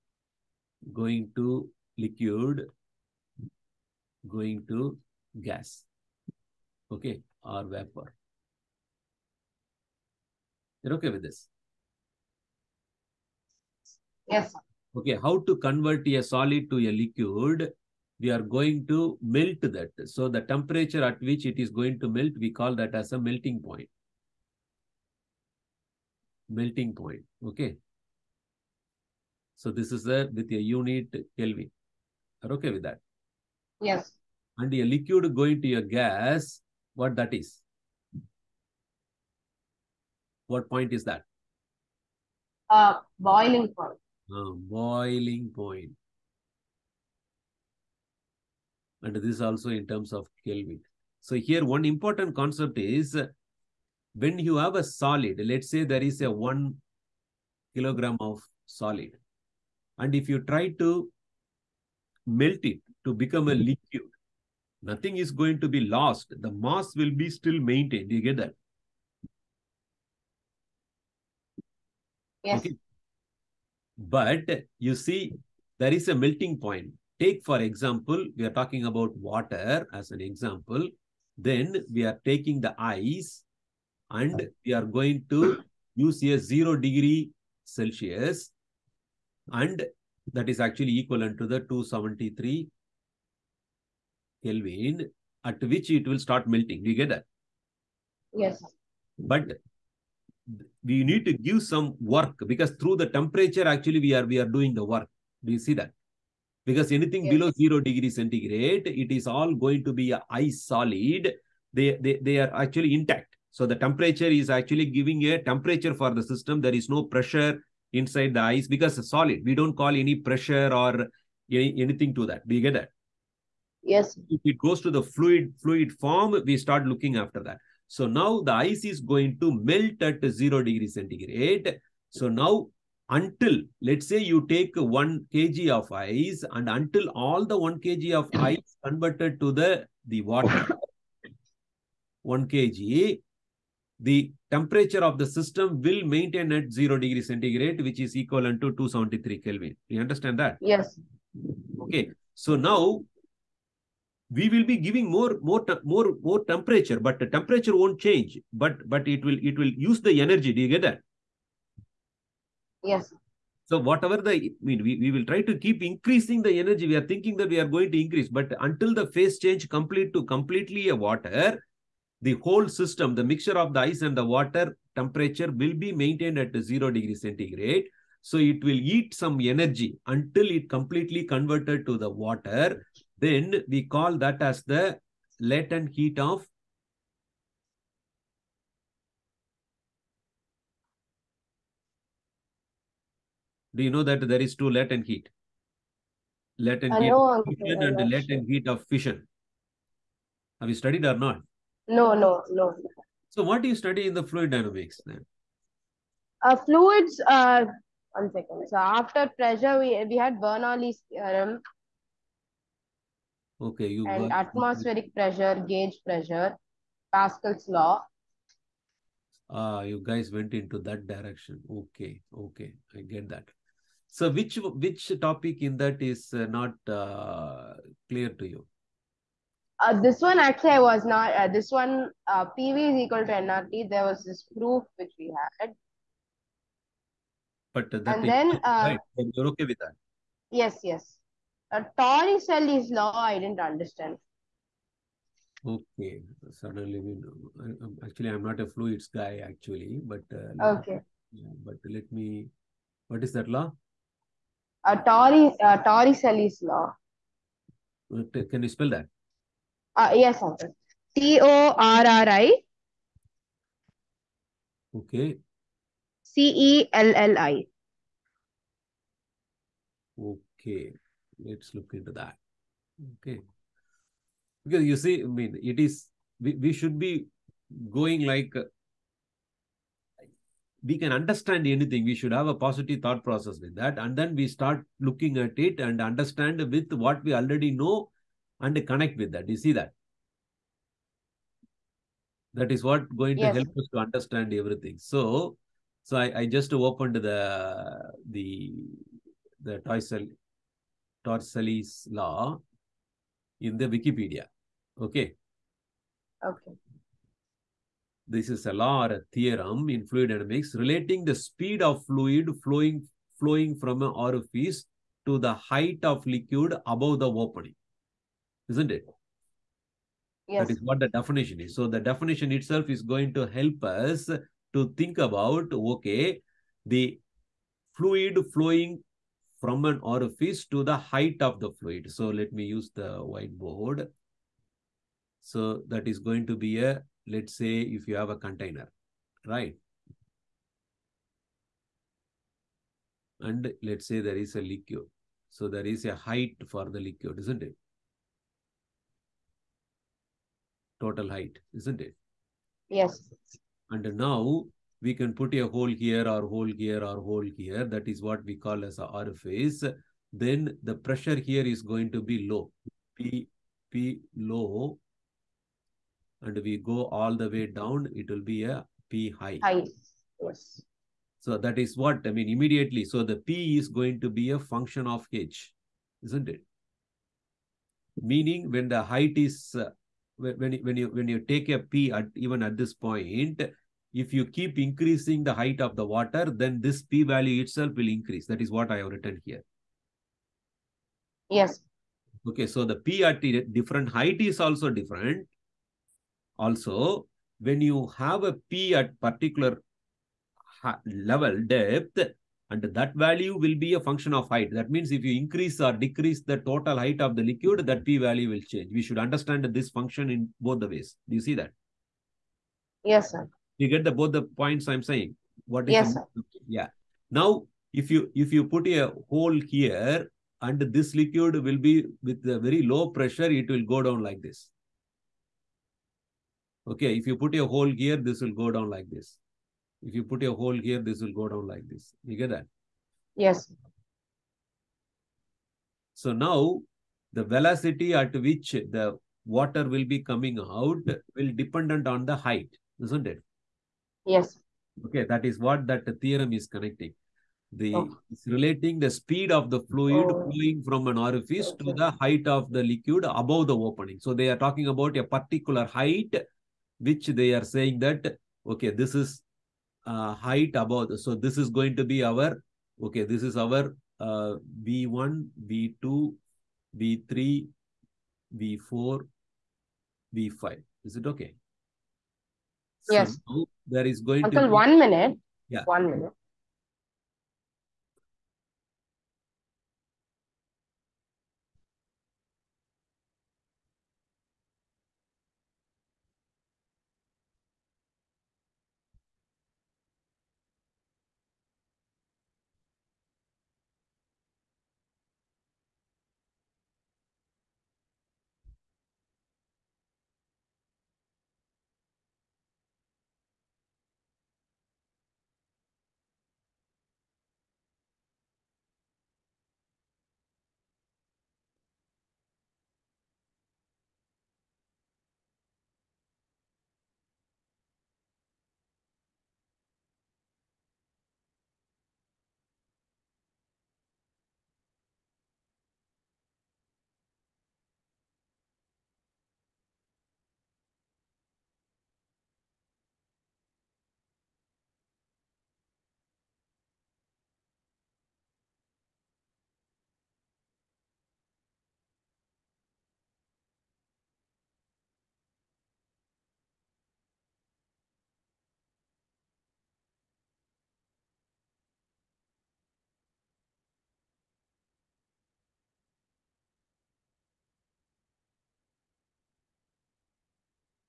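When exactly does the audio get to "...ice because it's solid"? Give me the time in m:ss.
1:58.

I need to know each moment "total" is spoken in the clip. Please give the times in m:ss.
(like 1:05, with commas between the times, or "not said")
5:51, 6:46.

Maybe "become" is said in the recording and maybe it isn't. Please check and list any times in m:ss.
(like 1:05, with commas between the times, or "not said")
1:03.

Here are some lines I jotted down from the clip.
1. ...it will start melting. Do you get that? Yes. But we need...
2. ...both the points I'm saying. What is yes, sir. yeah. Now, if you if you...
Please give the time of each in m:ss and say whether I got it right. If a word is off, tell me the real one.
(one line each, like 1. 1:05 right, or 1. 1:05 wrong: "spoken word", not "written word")
1. 1:35 right
2. 6:54 right.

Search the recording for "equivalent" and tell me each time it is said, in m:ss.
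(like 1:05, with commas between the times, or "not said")
1:30, 2:28.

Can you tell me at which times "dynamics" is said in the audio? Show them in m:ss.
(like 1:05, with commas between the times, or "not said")
3:24, 5:10.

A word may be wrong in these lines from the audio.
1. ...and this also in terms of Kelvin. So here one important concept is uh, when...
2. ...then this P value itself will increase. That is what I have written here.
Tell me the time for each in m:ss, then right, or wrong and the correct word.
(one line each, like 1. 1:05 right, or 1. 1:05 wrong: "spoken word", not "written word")
1. 0:49 right
2. 6:26 right.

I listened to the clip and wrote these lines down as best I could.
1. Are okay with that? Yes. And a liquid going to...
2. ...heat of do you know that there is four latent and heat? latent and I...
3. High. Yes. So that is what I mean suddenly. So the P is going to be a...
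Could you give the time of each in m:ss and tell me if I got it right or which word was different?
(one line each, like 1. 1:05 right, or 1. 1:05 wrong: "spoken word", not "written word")
1. 0:32 right
2. 3:05 wrong: "two", not "four"
3. 6:09 wrong: "immediately", not "suddenly".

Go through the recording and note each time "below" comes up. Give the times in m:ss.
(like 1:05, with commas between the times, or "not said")
1:47.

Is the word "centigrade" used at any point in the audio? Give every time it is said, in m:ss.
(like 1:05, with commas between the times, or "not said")
1:48, 2:10, 2:27, 2:57.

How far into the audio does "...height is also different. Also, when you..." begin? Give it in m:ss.
6:34.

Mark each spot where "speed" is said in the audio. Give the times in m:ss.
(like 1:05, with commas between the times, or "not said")
5:11, 7:29.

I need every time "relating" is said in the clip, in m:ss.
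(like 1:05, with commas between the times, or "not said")
5:10, 7:28.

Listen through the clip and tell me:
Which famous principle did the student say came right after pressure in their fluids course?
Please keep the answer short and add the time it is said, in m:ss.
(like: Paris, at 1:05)
Bernoulli's theorem, at 3:30.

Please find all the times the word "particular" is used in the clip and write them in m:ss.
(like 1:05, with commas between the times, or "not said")
6:39, 7:35.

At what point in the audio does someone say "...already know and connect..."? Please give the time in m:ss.
4:47.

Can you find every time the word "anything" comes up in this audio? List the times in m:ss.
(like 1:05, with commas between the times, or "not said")
1:46, 2:01, 4:41.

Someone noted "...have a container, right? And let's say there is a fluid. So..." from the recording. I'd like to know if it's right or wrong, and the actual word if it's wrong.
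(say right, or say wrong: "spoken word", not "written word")
wrong: "liquid", not "fluid".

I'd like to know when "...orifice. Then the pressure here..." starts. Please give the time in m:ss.
5:59.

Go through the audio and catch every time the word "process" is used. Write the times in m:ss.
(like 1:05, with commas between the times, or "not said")
4:43.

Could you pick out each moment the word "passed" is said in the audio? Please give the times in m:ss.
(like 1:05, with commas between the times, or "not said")
not said.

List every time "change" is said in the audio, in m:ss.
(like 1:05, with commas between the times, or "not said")
2:38, 2:49, 6:48.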